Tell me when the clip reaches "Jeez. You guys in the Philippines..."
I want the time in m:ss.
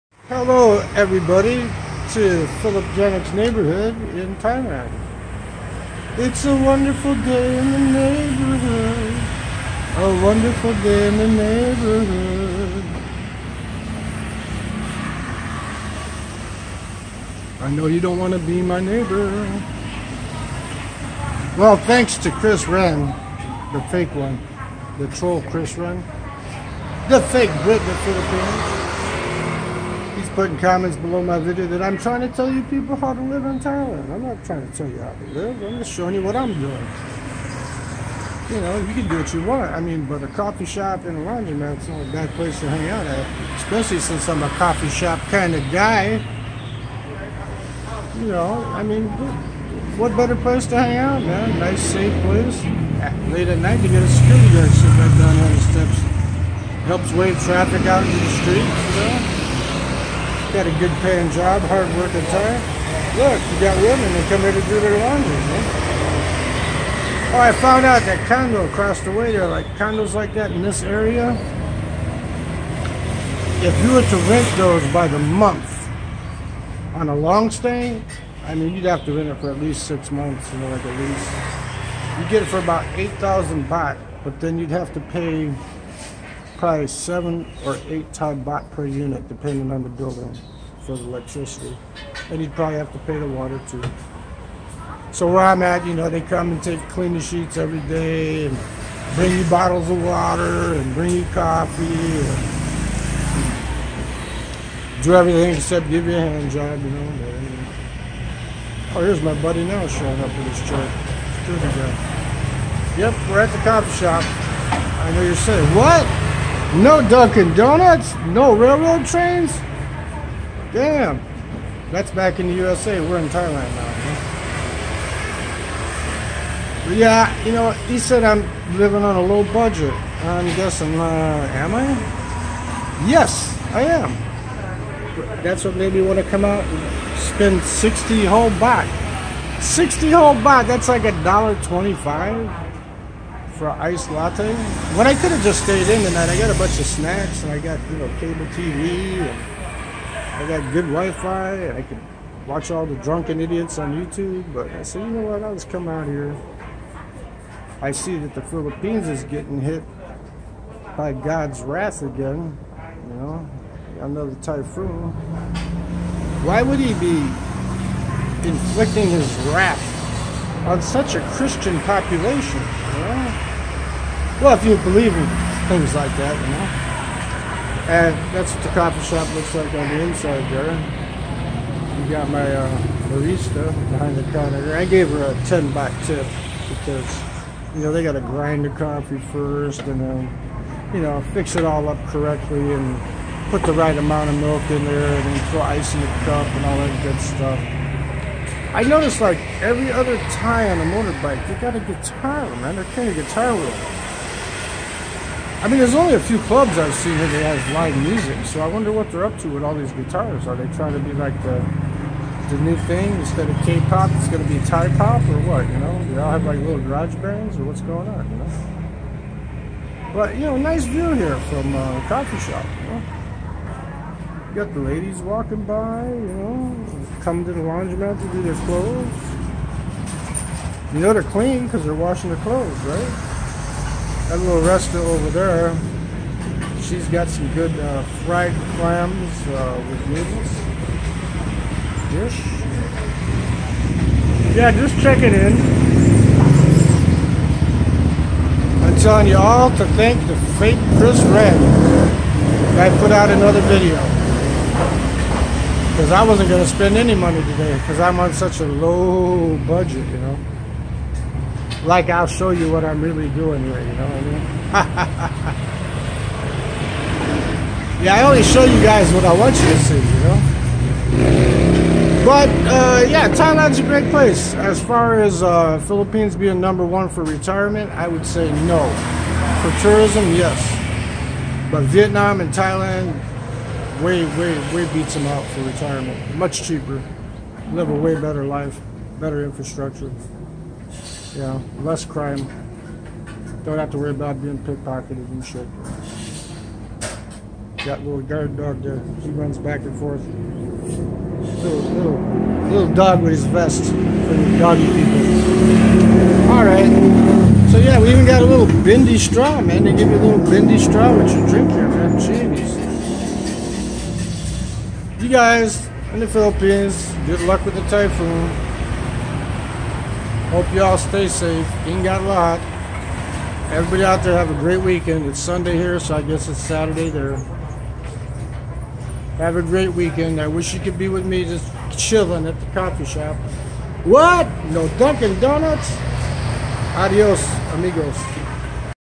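5:12.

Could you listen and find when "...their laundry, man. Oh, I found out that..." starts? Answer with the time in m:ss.
1:04.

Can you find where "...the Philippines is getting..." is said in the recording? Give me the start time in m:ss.
2:38.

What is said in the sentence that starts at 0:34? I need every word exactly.
I'm not trying to tell you how to live.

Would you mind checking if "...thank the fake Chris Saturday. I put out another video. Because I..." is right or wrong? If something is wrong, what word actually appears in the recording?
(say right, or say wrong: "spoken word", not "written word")
wrong: "Wren", not "Saturday".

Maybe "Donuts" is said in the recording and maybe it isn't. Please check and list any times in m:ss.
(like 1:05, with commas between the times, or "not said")
1:57, 5:35.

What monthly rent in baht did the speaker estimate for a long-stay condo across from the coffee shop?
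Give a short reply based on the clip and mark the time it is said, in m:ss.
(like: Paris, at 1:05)
8,000 baht, at 1:22.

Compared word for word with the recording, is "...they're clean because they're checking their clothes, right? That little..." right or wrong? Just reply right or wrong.
wrong.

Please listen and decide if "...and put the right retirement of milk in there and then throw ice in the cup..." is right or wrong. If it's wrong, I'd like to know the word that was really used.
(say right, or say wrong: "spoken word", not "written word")
wrong: "amount", not "retirement".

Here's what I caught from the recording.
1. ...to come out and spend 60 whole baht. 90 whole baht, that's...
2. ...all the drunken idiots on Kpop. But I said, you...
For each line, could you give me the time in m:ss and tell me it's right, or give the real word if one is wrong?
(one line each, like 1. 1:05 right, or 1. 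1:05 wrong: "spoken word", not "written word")
1. 2:16 wrong: "60", not "90"
2. 2:32 wrong: "YouTube", not "Kpop".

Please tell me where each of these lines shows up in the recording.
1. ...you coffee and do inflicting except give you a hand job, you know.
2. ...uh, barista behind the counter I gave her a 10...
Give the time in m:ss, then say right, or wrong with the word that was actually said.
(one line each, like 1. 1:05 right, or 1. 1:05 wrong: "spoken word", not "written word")
1. 1:41 wrong: "everything", not "inflicting"
2. 3:02 right.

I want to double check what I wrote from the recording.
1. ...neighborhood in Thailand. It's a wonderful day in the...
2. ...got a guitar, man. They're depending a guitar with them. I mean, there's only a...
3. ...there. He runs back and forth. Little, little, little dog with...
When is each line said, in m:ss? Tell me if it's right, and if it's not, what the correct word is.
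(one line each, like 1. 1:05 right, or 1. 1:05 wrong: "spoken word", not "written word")
1. 0:03 right
2. 3:21 wrong: "carrying", not "depending"
3. 4:58 right.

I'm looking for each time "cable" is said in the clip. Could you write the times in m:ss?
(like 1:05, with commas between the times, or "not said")
2:28.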